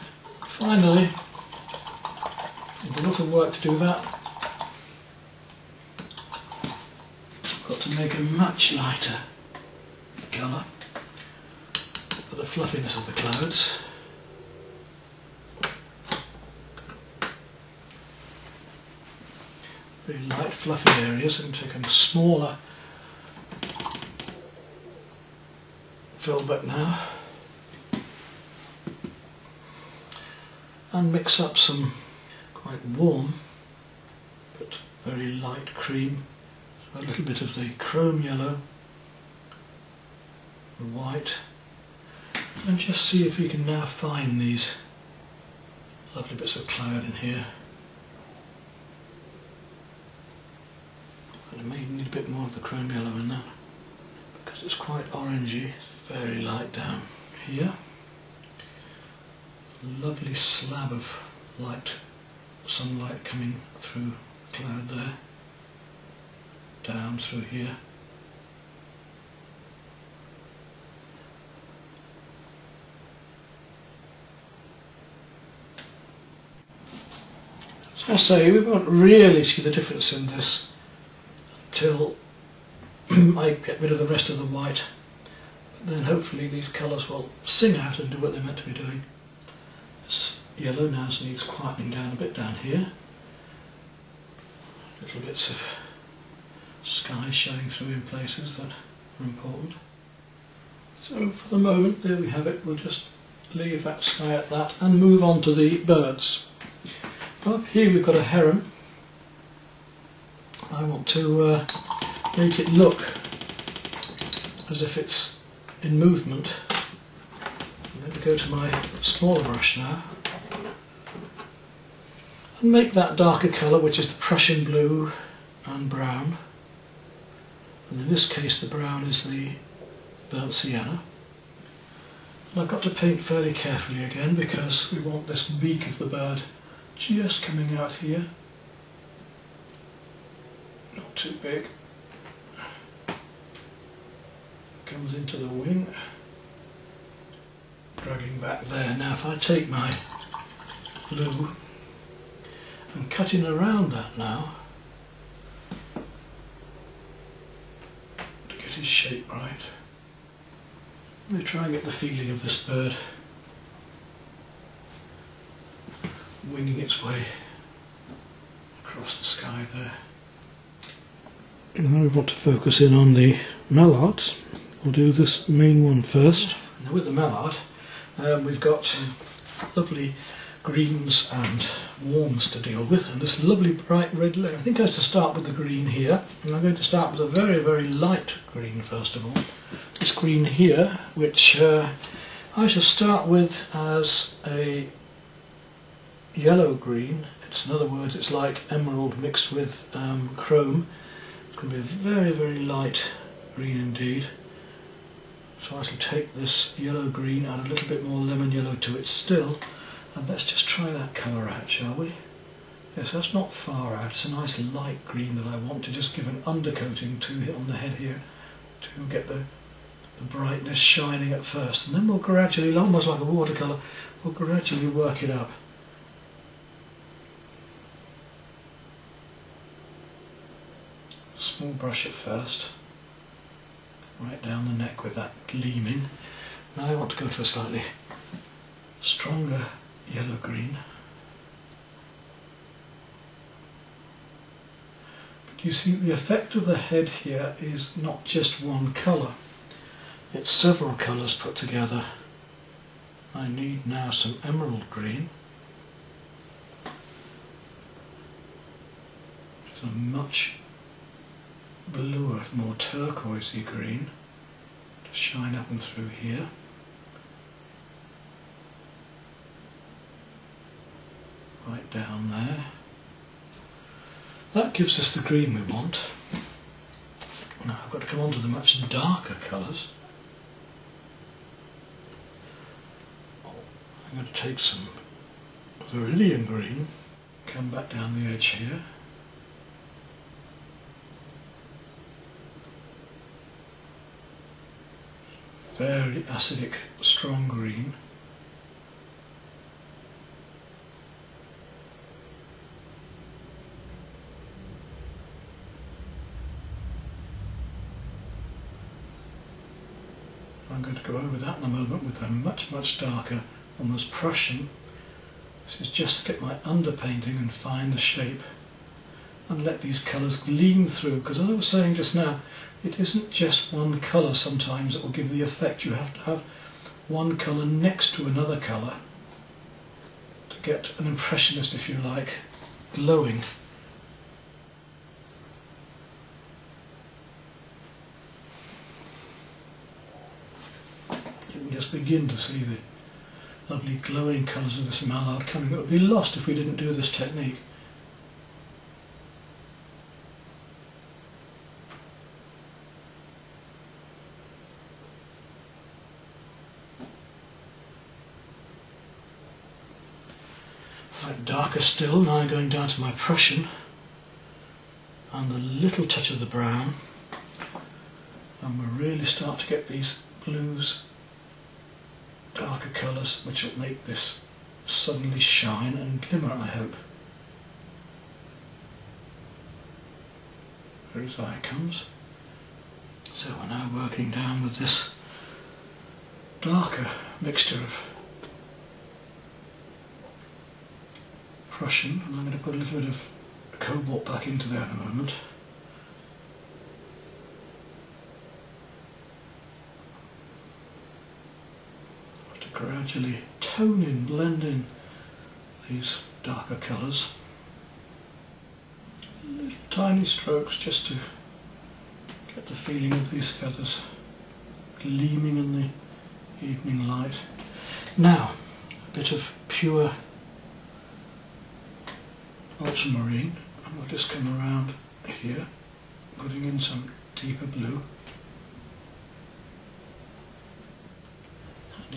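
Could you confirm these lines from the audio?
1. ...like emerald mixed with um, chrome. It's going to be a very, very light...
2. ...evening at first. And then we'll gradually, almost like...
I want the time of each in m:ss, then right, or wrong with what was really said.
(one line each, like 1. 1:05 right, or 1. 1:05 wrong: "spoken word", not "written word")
1. 3:18 right
2. 3:40 wrong: "shining", not "evening".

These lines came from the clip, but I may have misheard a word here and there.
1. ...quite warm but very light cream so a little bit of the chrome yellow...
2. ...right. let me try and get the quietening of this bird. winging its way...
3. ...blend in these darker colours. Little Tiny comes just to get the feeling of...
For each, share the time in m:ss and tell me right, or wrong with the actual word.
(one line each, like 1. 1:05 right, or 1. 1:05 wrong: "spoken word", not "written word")
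1. 0:32 right
2. 2:39 wrong: "feeling", not "quietening"
3. 6:44 wrong: "strokes", not "comes".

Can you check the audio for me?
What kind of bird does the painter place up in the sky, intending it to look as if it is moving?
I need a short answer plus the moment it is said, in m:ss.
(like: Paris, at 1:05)
heron, at 1:48.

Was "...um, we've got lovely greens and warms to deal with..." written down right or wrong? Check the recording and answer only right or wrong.
right.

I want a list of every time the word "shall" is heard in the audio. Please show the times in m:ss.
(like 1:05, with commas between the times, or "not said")
3:12, 3:25, 3:31.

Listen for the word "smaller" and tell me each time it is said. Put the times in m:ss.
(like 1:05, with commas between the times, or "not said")
0:21, 1:59.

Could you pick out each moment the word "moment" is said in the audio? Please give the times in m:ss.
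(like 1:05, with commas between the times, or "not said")
1:41, 5:11, 6:35.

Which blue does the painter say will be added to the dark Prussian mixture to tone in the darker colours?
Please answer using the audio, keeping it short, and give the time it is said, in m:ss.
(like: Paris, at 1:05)
cobalt, at 6:33.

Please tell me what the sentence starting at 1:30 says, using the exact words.
This yellow now needs quietening down a bit down here.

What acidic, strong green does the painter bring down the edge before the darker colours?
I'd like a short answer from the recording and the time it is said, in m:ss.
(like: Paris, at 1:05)
viridian green, at 4:45.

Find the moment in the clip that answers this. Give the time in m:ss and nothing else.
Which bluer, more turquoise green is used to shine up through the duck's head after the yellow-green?
4:14.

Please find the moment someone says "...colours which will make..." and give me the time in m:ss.
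6:12.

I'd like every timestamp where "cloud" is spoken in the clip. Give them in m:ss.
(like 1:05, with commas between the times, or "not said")
0:13, 0:46, 1:04.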